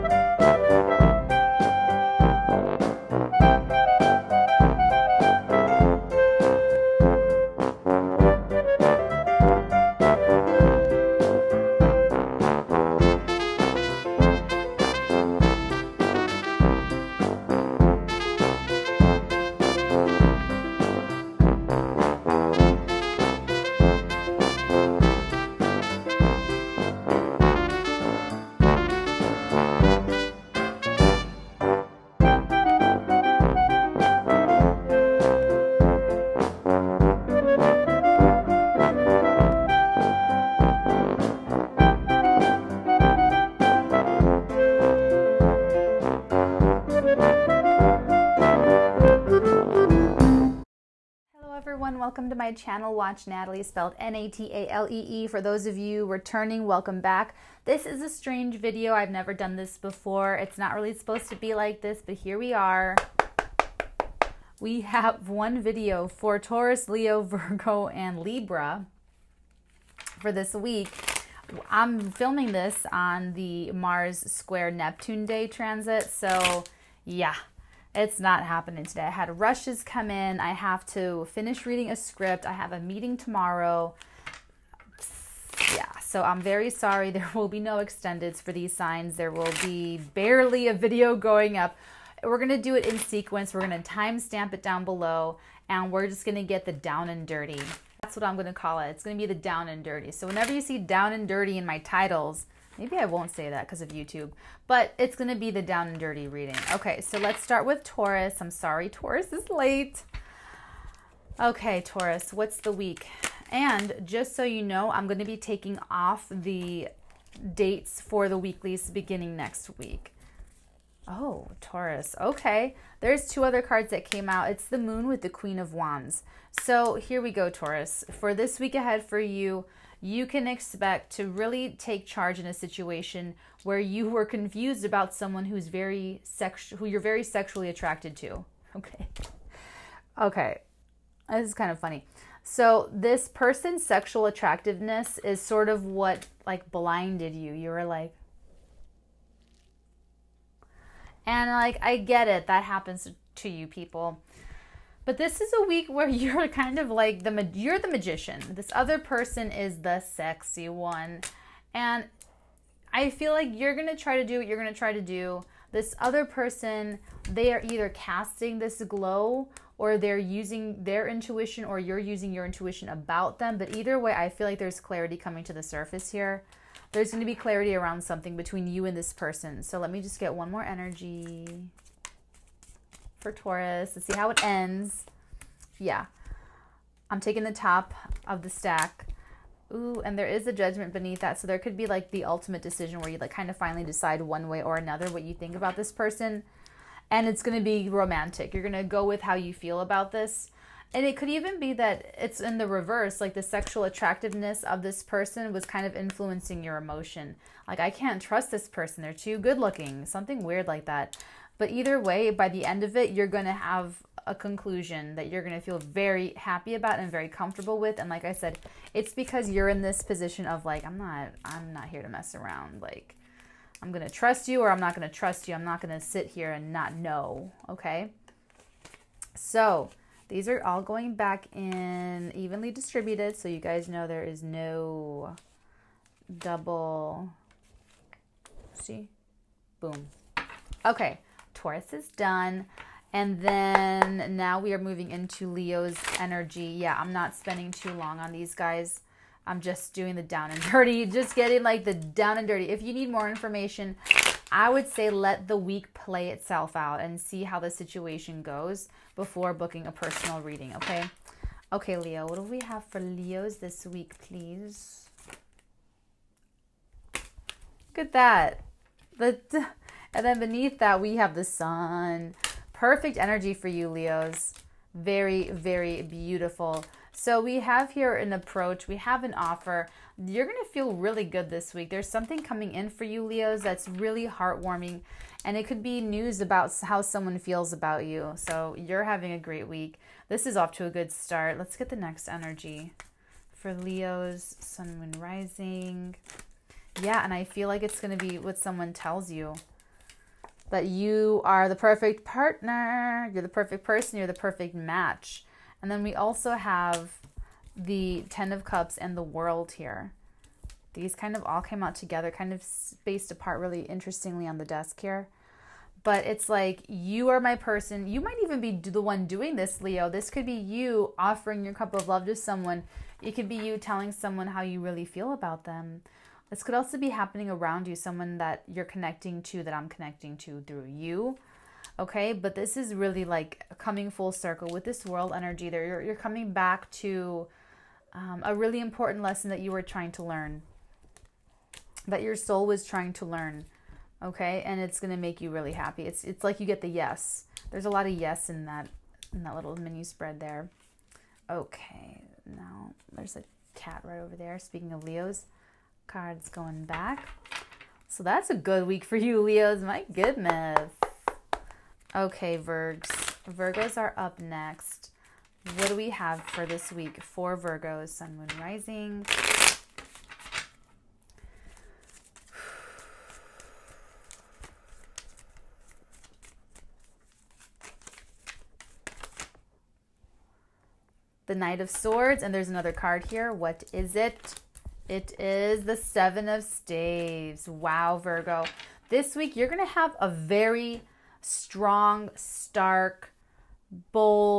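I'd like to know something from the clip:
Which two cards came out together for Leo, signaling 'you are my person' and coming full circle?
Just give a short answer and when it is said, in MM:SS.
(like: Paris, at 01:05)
Ten of Cups and the World, at 05:08.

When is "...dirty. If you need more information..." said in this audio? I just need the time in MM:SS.
04:12.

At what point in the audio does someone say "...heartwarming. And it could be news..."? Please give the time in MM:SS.
04:44.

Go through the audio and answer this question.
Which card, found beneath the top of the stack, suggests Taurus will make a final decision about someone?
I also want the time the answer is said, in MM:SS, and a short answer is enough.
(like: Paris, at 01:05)
Judgment, at 03:10.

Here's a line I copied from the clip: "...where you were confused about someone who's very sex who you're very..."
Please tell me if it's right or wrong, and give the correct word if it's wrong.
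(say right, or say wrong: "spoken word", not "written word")
right.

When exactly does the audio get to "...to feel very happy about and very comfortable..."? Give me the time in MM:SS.
03:35.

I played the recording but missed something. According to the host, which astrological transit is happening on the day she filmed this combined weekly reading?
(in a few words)
Mars square Neptune.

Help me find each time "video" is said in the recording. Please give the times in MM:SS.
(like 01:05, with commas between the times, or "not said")
00:58, 01:05, 01:30.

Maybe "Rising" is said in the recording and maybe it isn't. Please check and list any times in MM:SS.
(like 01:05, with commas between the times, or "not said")
04:55, 06:08.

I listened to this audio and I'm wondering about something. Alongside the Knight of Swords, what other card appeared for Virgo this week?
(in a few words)
Seven of Staves.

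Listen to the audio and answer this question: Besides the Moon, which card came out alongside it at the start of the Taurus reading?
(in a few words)
Queen of Wands.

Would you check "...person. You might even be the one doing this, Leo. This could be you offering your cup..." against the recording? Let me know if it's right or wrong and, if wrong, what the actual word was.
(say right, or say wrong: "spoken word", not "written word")
right.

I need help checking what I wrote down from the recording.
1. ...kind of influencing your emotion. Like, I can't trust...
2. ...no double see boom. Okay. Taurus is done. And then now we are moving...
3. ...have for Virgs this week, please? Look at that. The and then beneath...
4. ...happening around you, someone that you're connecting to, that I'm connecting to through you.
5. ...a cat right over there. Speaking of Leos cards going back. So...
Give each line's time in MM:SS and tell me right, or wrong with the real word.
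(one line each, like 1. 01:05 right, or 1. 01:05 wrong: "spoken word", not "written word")
1. 03:25 right
2. 03:54 right
3. 04:22 wrong: "Leos", not "Virgs"
4. 05:27 right
5. 05:53 right.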